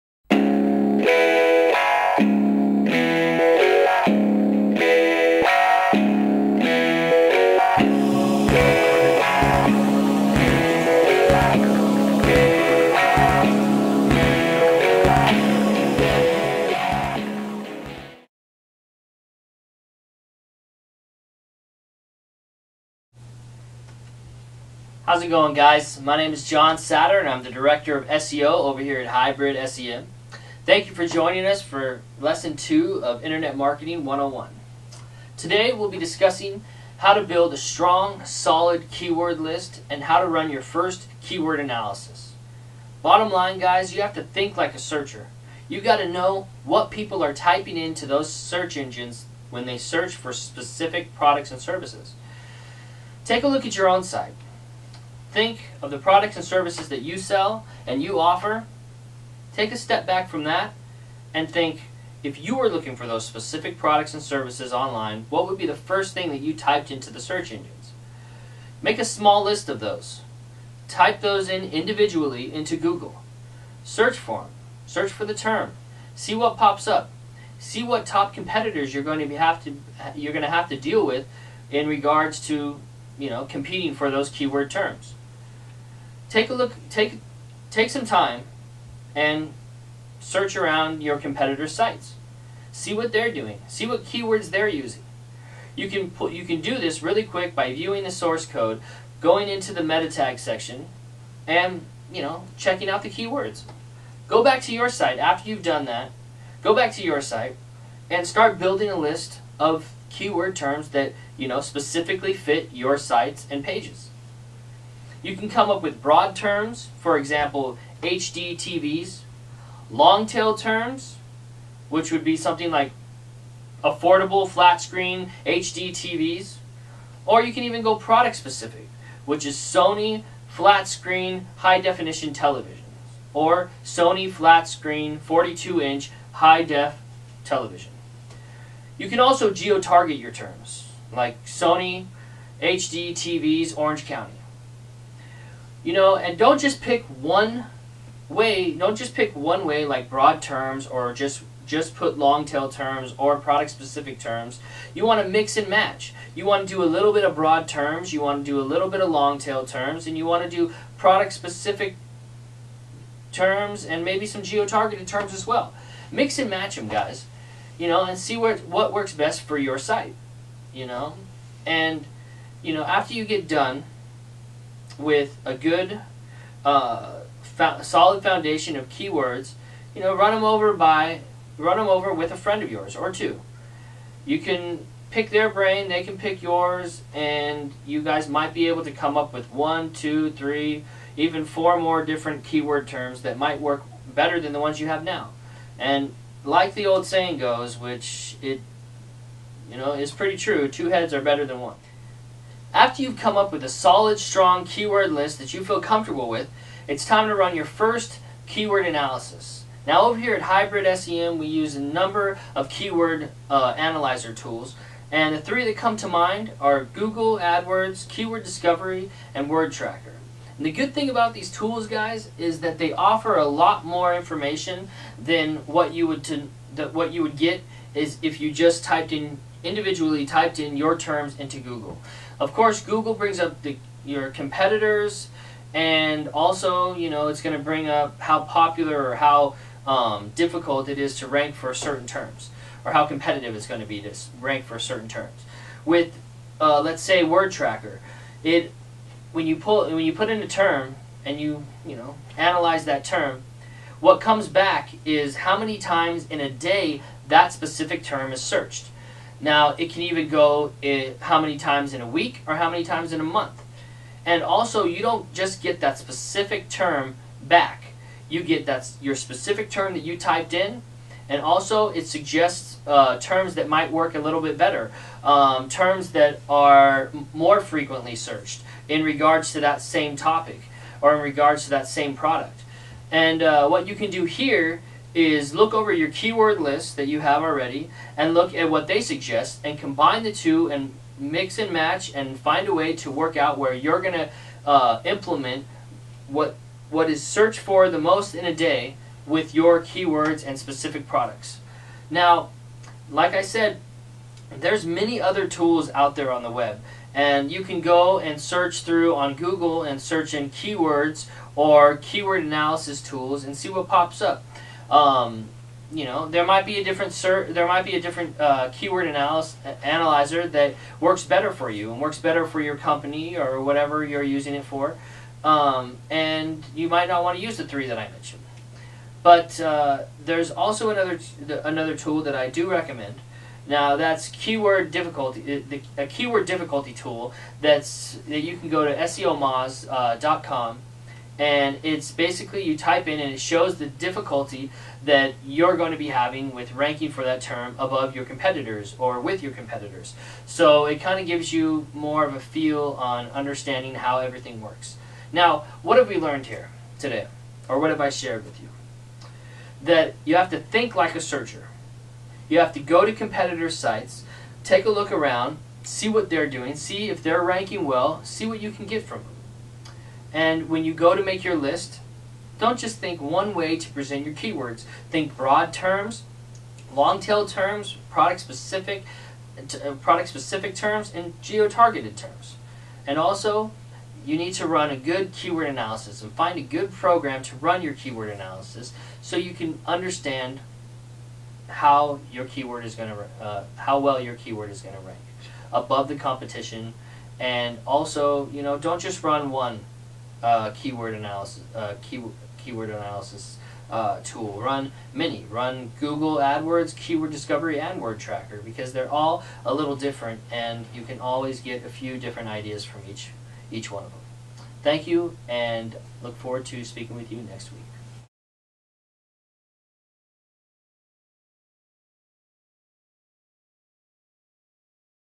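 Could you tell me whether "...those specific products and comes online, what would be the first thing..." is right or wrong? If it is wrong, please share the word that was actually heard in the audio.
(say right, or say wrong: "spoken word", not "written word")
wrong: "services", not "comes".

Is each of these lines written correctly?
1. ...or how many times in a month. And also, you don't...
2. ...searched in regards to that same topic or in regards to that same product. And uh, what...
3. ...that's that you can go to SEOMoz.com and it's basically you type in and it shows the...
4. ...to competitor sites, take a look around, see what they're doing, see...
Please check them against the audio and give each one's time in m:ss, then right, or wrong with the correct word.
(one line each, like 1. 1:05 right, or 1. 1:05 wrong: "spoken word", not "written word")
1. 4:22 right
2. 4:38 right
3. 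5:37 right
4. 6:03 right.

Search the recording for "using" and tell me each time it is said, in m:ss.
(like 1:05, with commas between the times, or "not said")
1:34, 5:24.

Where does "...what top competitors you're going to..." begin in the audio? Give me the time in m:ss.
1:17.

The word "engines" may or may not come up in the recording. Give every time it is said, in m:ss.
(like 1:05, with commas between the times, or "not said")
0:48, 1:07.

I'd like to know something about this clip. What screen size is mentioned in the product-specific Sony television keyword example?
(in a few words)
42 inch.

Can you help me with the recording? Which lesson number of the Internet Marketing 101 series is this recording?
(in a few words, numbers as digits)
Lesson 2.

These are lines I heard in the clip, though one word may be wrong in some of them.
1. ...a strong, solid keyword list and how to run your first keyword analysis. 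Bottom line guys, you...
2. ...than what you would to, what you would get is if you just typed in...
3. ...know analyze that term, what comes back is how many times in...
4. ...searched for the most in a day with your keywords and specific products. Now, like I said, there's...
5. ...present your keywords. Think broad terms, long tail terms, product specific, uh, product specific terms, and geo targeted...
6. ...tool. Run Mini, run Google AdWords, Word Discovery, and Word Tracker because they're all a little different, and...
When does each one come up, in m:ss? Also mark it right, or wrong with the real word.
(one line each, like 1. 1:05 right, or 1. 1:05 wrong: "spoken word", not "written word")
1. 0:37 right
2. 3:45 right
3. 4:11 right
4. 4:57 right
5. 6:13 right
6. 6:44 wrong: "Keyword", not "Word".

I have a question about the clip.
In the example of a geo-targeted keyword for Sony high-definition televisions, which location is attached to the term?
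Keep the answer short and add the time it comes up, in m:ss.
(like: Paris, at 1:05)
Orange County, at 2:23.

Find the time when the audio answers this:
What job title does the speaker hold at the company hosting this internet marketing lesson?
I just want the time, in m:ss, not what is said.
0:27.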